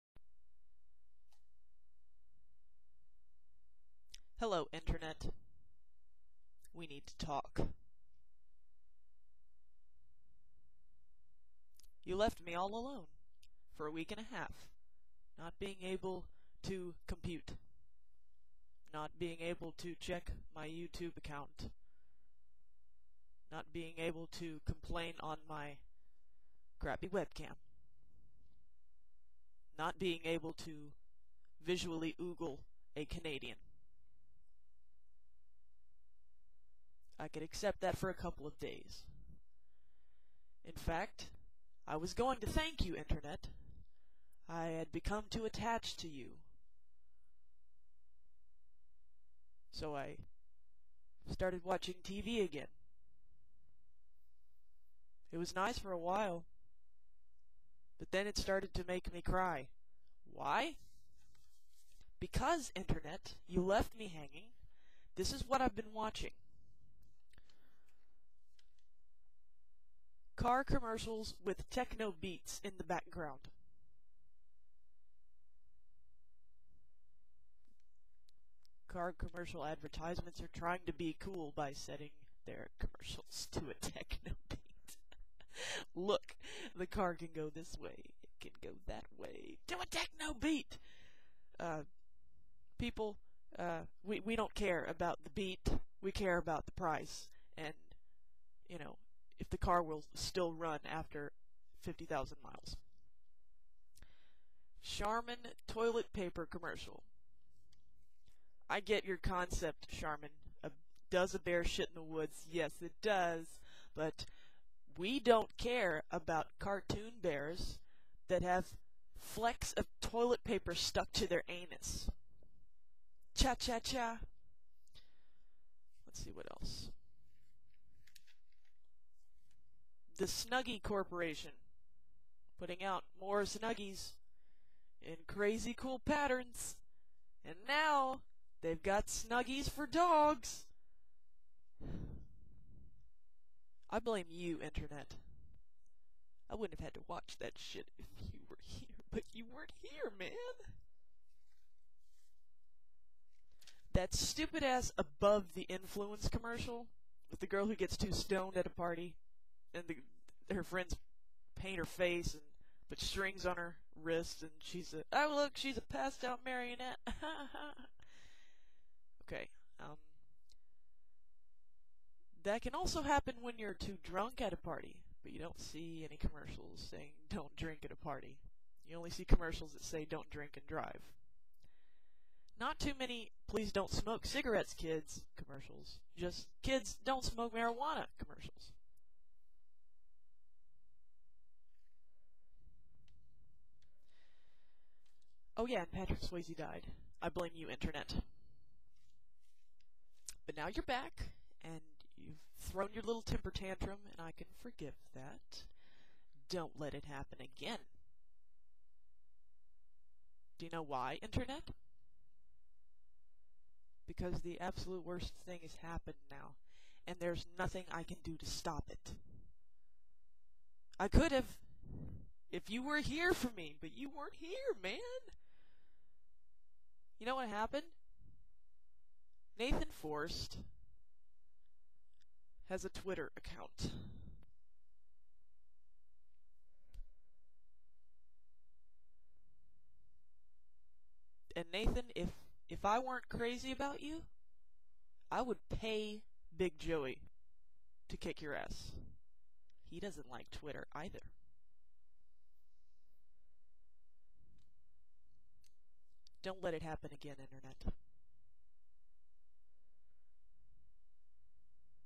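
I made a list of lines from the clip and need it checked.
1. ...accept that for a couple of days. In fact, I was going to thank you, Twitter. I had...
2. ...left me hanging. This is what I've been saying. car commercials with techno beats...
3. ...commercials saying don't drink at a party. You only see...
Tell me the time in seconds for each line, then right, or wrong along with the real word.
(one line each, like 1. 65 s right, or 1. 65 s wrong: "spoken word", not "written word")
1. 37 s wrong: "Internet", not "Twitter"
2. 63 s wrong: "watching", not "saying"
3. 176 s right.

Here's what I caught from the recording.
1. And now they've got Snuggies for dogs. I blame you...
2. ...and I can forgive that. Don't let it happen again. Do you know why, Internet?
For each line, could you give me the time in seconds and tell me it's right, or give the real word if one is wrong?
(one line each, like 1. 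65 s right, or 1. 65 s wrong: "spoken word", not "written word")
1. 137 s right
2. 204 s right.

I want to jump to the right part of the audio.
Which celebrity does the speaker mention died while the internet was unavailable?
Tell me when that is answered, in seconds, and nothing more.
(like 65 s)
195 s.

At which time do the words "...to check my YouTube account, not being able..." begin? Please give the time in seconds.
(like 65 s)
19 s.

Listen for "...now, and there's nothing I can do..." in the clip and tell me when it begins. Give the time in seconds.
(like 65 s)
216 s.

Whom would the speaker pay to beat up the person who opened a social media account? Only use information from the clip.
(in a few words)
Big Joey.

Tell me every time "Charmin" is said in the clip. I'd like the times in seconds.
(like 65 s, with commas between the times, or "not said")
104 s, 109 s.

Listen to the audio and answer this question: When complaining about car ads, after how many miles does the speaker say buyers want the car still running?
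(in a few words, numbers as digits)
50,000.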